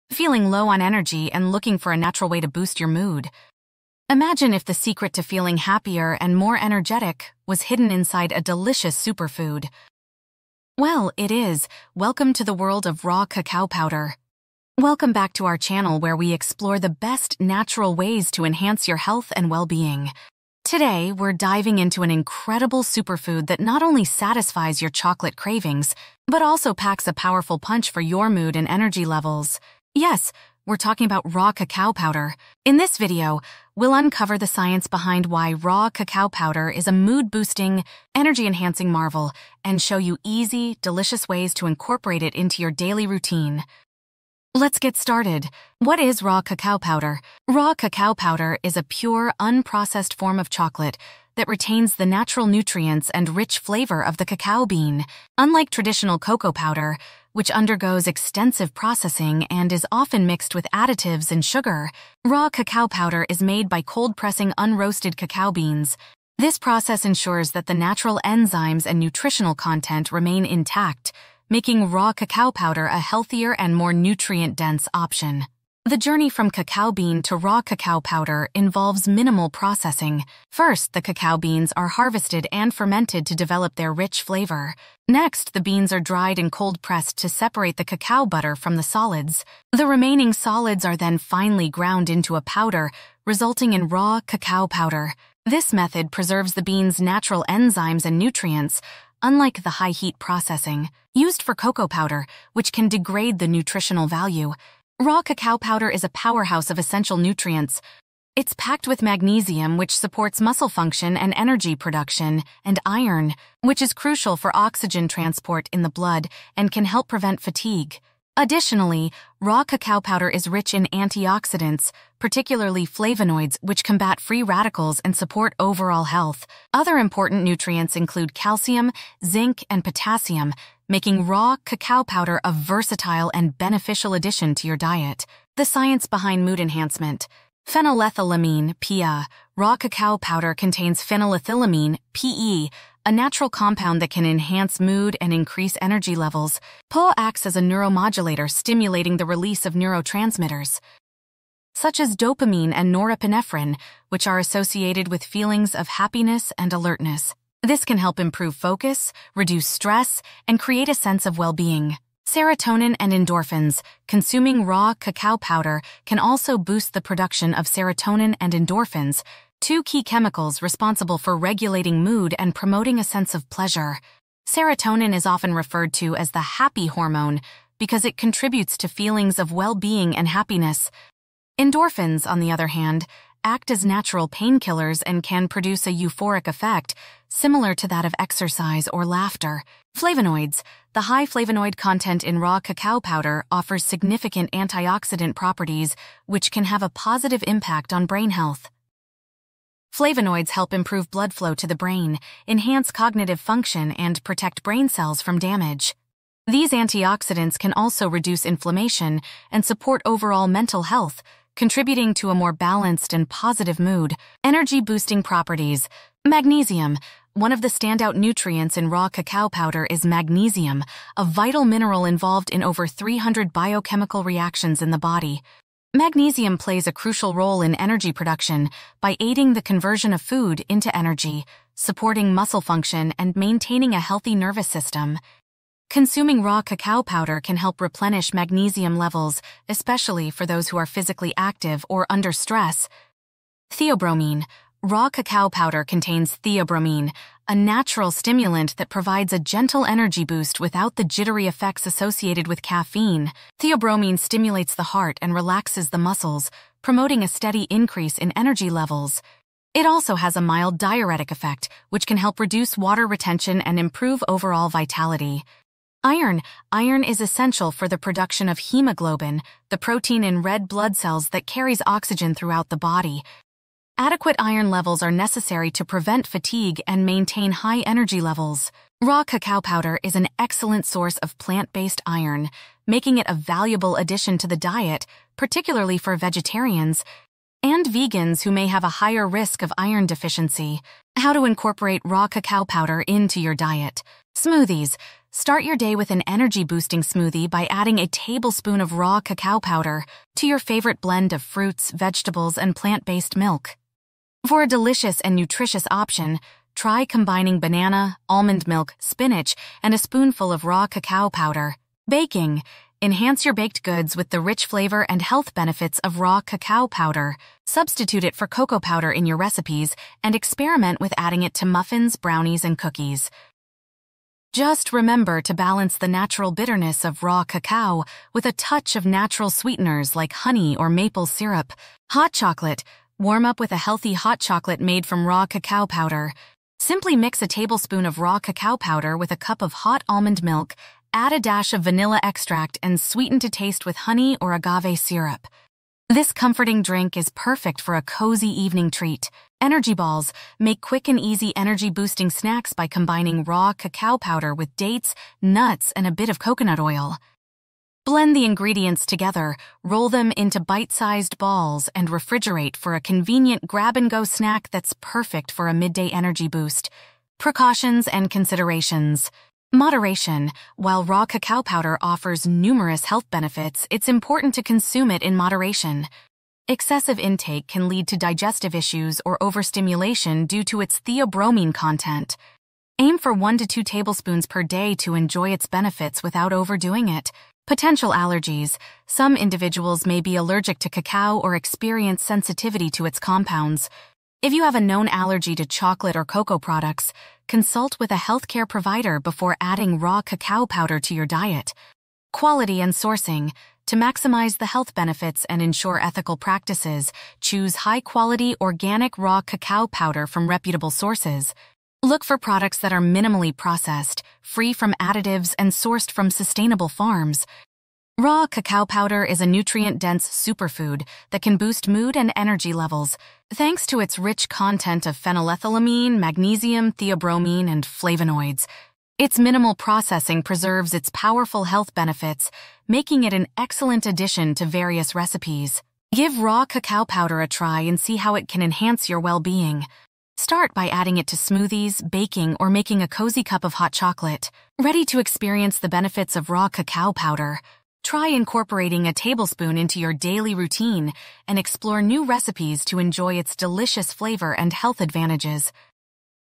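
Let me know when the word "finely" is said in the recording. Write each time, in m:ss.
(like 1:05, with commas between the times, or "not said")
1:31.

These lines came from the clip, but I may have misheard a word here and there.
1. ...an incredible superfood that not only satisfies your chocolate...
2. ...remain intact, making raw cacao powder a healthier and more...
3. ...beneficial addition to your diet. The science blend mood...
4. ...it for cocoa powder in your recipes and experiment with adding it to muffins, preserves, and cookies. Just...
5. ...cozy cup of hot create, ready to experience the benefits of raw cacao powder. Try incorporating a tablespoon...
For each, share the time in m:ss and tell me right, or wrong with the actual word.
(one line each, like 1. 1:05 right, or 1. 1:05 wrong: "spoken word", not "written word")
1. 0:22 right
2. 1:10 right
3. 2:13 wrong: "behind", not "blend"
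4. 5:18 wrong: "brownies", not "preserves"
5. 7:23 wrong: "chocolate", not "create".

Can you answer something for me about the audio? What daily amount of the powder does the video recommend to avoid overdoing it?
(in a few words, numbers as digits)
1 to 2 tablespoons.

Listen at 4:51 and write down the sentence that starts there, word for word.
How to incorporate raw cacao powder into your diet.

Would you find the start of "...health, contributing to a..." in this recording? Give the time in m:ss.
3:30.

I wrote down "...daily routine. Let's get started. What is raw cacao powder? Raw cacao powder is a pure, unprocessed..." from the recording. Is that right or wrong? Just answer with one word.
right.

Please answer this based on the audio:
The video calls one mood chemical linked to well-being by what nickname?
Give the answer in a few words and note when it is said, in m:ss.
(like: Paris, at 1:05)
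the happy hormone, at 2:56.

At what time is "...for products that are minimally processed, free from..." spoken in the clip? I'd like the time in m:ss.
6:52.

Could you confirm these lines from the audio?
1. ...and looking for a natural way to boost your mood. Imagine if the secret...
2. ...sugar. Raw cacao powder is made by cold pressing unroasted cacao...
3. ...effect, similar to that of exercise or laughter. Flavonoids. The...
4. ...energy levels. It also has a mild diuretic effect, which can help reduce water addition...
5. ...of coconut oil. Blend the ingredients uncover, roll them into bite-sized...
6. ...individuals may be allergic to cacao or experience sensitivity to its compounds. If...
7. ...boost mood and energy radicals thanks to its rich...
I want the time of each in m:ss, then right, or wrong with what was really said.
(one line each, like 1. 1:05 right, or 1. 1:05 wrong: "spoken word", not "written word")
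1. 0:01 right
2. 1:01 right
3. 3:06 right
4. 4:18 wrong: "retention", not "addition"
5. 5:56 wrong: "together", not "uncover"
6. 6:29 right
7. 7:01 wrong: "levels", not "radicals".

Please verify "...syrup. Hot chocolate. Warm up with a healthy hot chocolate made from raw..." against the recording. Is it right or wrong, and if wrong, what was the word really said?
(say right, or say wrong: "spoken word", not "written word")
right.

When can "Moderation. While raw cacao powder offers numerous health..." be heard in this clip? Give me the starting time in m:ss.
6:09.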